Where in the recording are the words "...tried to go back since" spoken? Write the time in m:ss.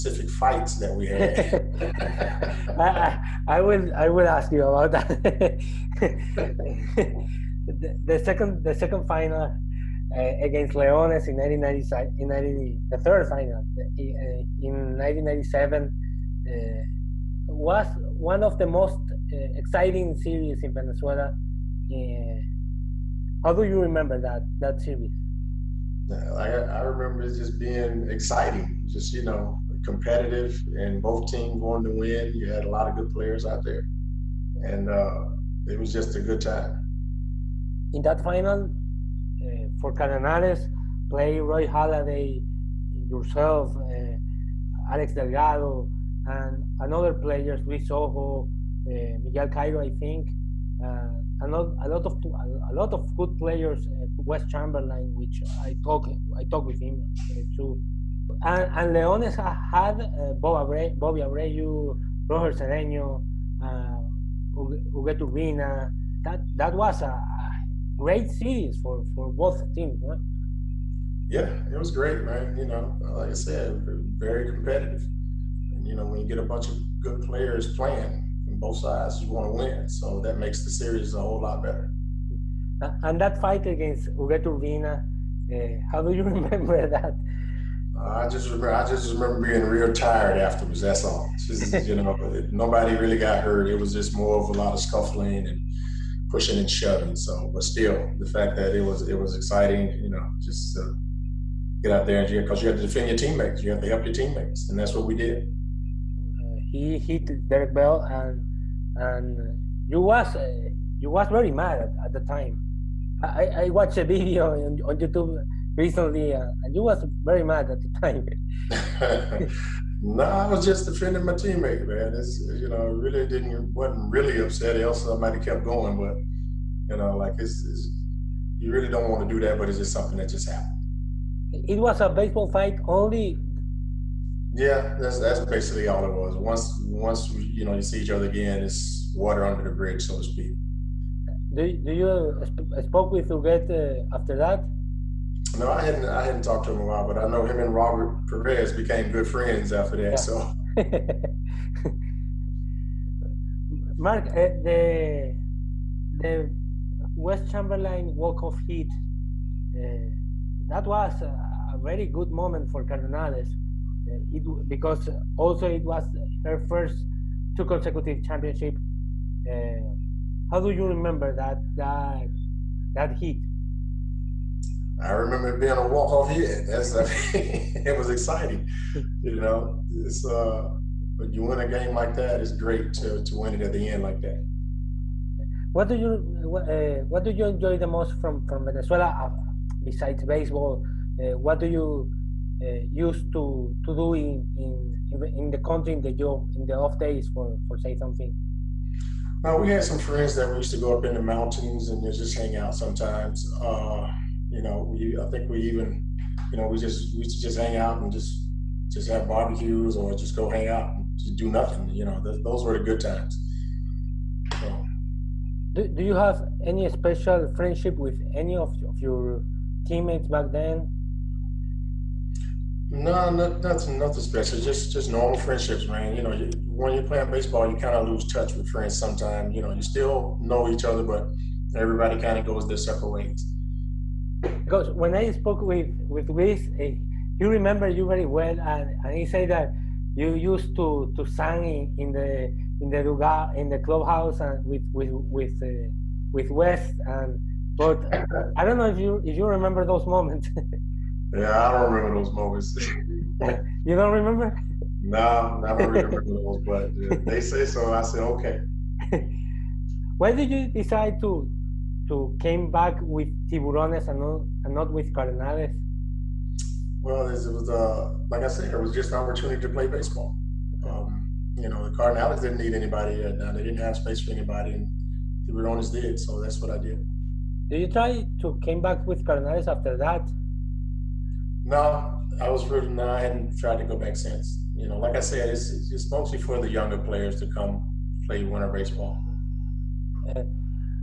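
4:43.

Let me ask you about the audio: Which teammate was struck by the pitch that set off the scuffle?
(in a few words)
Derek Bell.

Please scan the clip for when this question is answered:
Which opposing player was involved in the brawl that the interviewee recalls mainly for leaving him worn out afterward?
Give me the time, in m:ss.
1:24.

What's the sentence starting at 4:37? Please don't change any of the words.
Did you try to came back with Cardinals after that?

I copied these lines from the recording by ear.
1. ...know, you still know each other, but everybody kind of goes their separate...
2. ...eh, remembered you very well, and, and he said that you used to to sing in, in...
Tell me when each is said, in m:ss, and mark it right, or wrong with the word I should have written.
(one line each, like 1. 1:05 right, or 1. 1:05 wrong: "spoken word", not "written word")
1. 3:49 right
2. 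3:57 right.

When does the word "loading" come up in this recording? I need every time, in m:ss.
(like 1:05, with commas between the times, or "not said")
not said.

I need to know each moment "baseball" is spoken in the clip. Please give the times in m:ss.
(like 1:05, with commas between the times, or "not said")
2:12, 3:10, 3:47, 4:29, 4:48.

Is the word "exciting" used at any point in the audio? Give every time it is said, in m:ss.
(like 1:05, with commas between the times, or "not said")
0:19, 0:28, 1:39, 2:58.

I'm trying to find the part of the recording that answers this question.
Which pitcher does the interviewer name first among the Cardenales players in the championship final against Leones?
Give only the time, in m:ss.
0:41.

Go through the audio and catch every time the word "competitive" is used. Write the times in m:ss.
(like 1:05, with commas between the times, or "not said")
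0:29, 1:14.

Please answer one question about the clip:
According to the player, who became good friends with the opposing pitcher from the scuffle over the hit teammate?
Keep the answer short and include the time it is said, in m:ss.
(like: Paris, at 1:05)
Robert Perez, at 2:27.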